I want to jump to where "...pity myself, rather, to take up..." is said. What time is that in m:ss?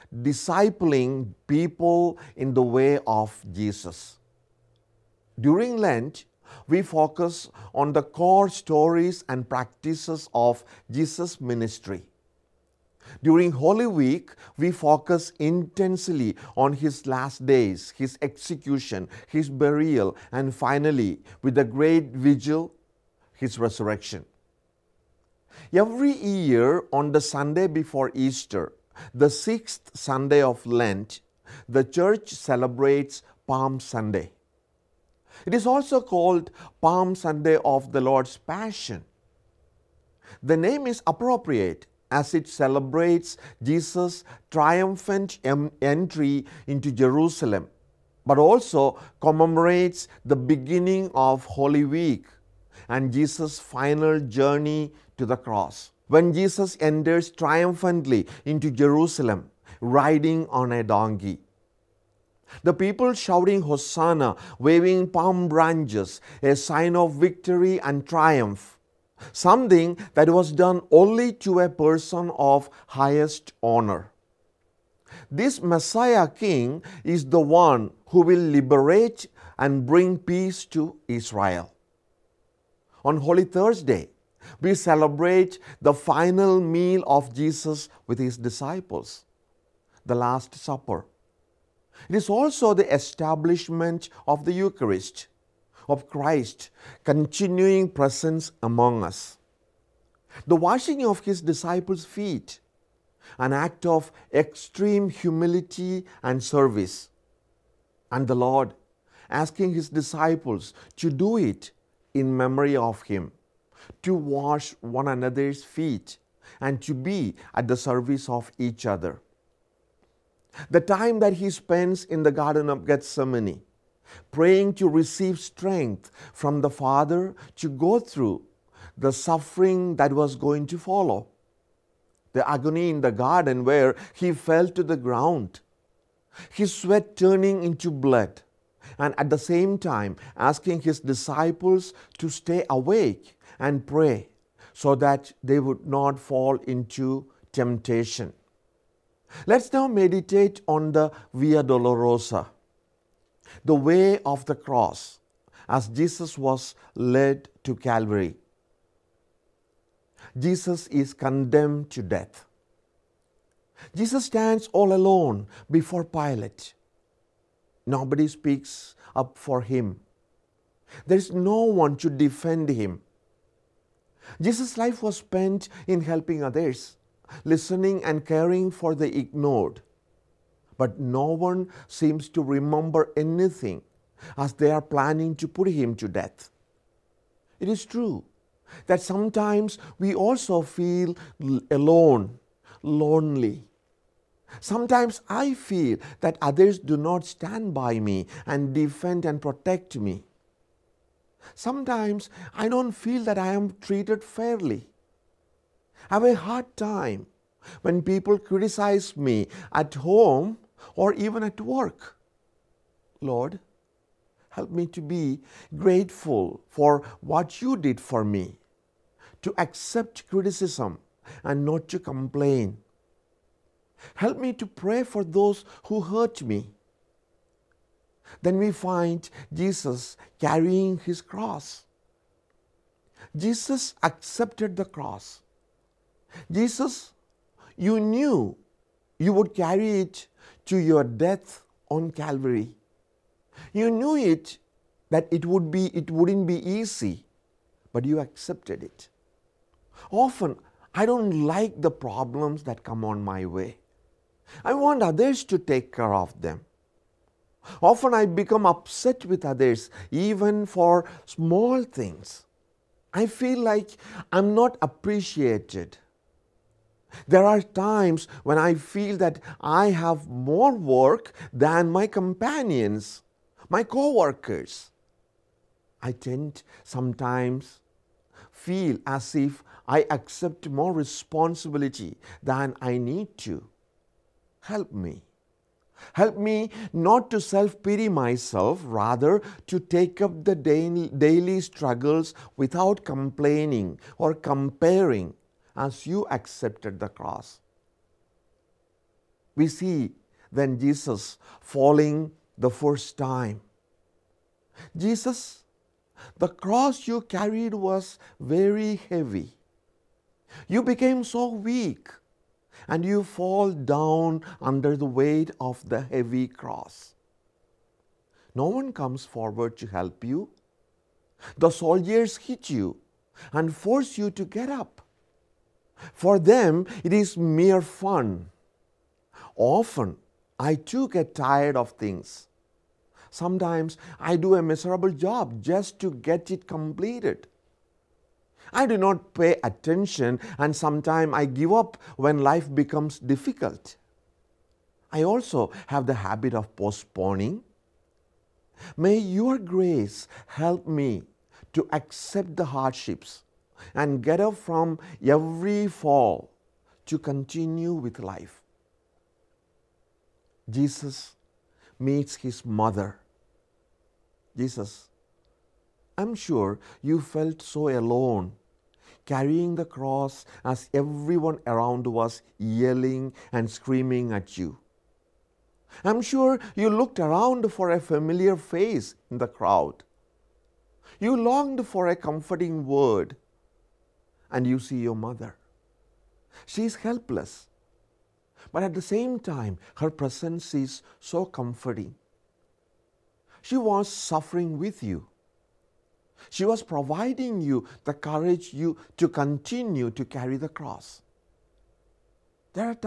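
4:47.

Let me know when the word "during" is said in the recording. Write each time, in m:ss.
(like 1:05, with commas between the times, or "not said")
0:05, 0:13.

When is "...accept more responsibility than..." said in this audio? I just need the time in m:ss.
4:40.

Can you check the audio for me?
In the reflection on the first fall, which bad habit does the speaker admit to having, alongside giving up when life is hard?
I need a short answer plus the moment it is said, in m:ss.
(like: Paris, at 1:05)
postponing, at 5:46.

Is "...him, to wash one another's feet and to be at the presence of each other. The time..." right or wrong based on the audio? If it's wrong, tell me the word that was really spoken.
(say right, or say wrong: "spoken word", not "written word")
wrong: "service", not "presence".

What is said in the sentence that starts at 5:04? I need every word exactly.
Jesus, the cross you carried was very heavy.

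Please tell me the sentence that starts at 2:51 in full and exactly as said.
There is no one to defend him.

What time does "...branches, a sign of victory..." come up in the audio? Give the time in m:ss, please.
1:05.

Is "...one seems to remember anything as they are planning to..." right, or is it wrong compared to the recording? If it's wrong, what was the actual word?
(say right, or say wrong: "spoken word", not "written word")
right.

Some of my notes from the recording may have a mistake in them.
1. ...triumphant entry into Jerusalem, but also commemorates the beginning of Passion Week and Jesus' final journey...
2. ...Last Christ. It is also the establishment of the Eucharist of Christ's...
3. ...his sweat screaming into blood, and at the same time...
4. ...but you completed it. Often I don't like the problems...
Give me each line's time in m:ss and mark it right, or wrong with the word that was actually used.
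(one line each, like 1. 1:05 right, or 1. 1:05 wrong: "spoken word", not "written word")
1. 0:44 wrong: "Holy", not "Passion"
2. 1:30 wrong: "Supper", not "Christ"
3. 2:16 wrong: "turning", not "screaming"
4. 4:07 wrong: "accepted", not "completed".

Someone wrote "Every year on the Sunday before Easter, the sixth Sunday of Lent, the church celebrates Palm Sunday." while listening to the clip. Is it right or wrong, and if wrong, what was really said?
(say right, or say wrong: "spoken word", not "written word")
right.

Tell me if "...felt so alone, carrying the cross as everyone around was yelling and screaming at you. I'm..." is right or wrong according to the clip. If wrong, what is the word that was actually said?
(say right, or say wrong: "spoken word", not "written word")
right.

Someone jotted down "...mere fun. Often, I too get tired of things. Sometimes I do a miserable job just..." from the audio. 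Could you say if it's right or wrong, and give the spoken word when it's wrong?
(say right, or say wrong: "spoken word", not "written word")
right.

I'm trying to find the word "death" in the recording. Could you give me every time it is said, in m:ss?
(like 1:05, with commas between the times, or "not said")
2:42, 3:06, 4:01.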